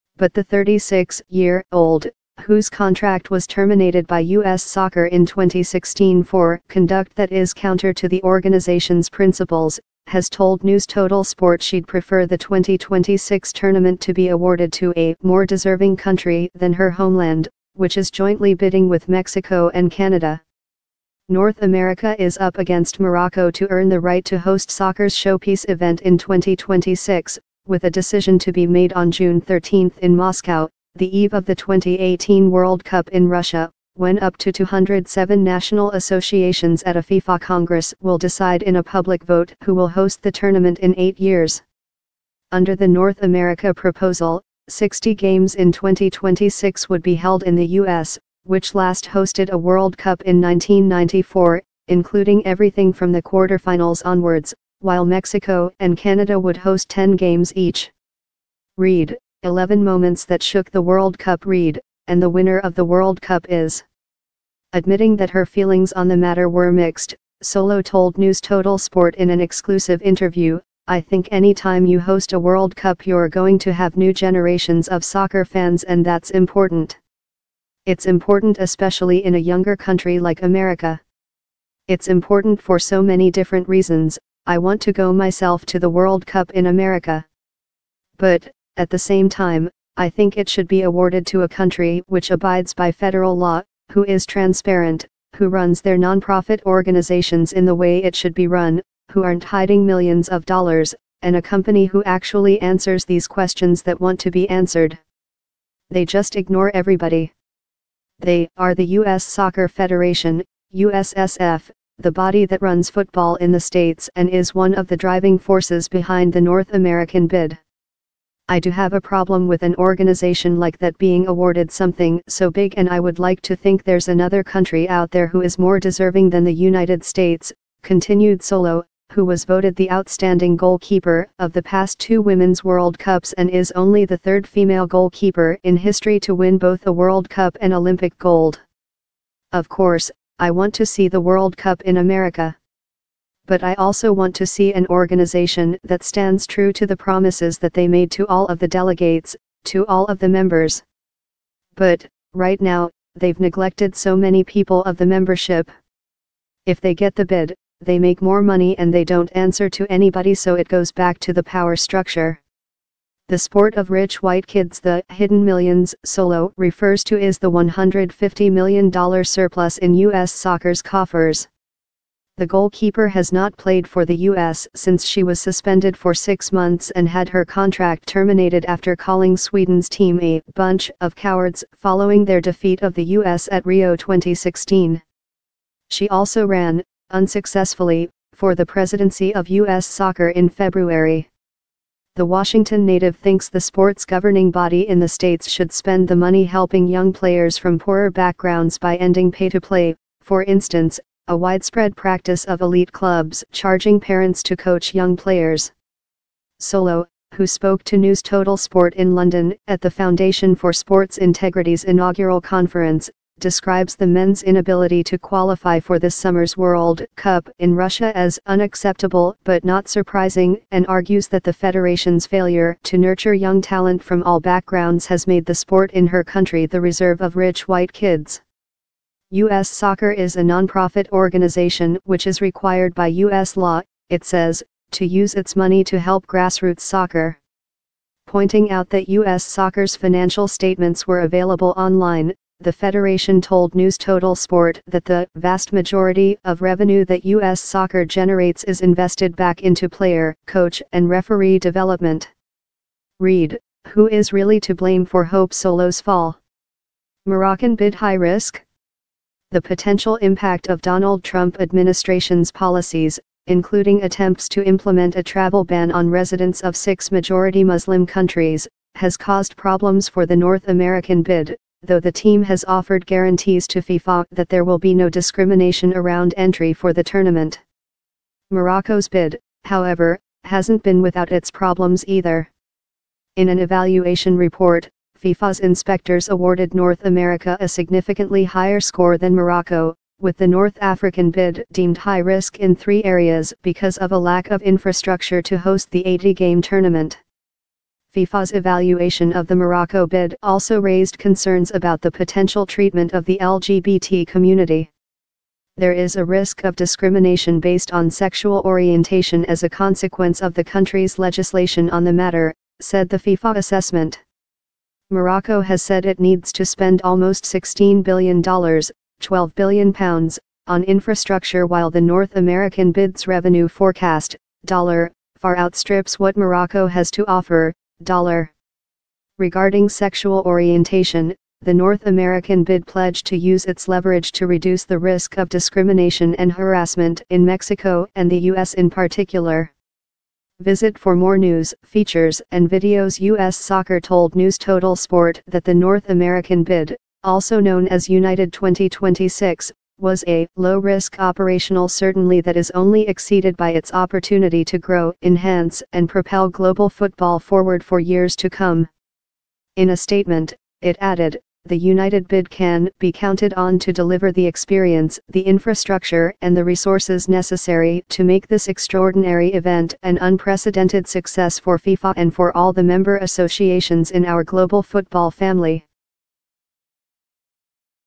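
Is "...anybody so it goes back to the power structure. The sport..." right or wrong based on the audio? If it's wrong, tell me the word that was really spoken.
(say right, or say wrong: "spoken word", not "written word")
right.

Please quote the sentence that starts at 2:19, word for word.
Of course, I want to see the World Cup in America.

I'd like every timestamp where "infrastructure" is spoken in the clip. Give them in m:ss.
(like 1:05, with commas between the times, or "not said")
4:54, 5:20, 6:05.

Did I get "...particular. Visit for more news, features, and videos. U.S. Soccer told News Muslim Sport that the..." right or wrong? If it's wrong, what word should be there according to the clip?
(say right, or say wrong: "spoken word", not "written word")
wrong: "Total", not "Muslim".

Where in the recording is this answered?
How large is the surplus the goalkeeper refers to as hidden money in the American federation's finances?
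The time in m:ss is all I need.
2:47.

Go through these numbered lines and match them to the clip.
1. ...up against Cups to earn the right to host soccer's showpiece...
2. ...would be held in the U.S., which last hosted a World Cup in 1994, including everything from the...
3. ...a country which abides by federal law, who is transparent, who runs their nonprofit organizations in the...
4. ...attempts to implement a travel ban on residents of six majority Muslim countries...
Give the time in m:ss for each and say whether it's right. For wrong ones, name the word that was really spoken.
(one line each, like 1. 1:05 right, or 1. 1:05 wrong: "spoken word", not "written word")
1. 0:22 wrong: "Morocco", not "Cups"
2. 0:46 right
3. 1:31 right
4. 4:24 right.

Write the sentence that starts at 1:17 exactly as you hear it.
It's important especially in a younger country like America.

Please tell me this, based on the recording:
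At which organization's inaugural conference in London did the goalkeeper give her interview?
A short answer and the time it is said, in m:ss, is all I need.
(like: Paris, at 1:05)
Foundation for Sports Integrity, at 3:29.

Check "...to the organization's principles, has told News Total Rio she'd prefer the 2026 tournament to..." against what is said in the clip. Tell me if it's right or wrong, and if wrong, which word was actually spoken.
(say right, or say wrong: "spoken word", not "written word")
wrong: "Sport", not "Rio".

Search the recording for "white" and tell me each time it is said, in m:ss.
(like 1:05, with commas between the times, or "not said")
2:44, 3:47.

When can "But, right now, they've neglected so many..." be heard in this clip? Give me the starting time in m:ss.
2:31.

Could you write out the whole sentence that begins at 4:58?
FIFA's evaluation of the Morocco bid also raised concerns about the potential treatment of the LGBT community.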